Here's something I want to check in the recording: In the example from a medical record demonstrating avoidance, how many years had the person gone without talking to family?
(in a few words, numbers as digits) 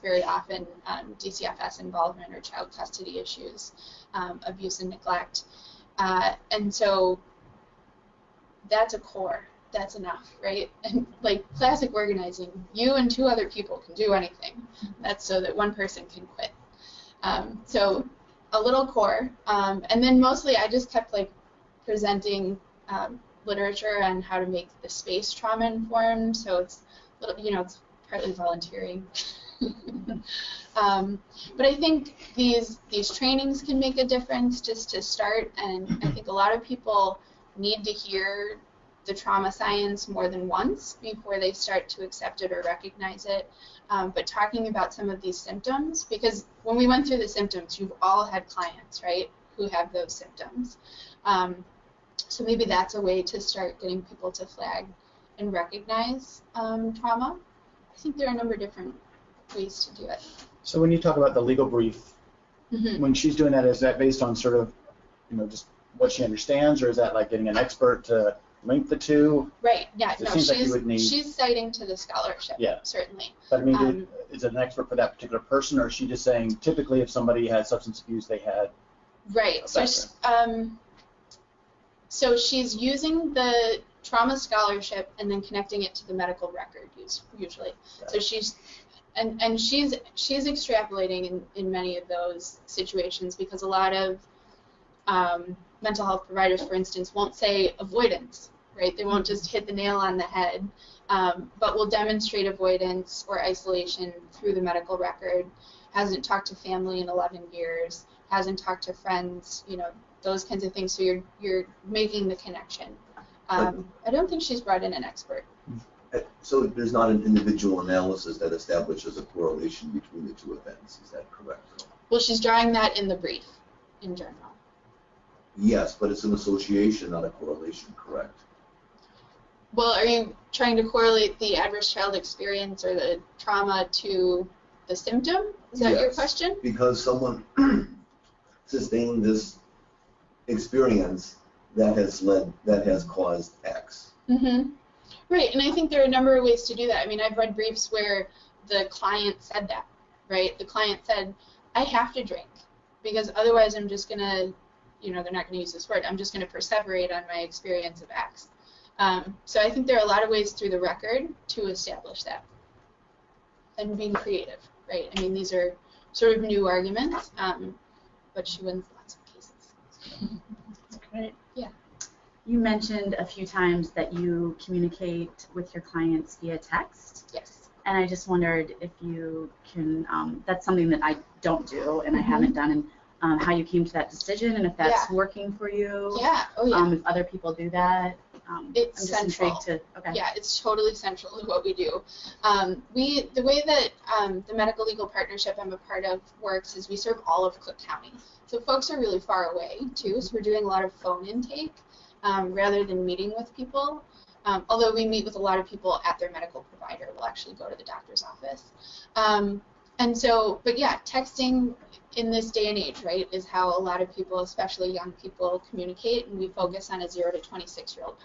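11.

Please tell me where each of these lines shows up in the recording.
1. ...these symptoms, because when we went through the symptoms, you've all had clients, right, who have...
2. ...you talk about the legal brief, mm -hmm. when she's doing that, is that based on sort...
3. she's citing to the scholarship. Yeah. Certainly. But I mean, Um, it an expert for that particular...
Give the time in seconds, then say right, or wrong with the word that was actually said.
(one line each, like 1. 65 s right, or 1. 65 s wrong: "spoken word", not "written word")
1. 45 s right
2. 60 s right
3. 70 s right.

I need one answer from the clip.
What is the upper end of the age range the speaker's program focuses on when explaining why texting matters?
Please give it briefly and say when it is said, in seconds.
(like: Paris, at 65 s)
26, at 217 s.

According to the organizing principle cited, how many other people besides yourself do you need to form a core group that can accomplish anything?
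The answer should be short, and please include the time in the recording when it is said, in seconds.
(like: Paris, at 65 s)
2, at 13 s.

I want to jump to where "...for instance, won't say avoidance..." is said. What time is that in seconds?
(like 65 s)
96 s.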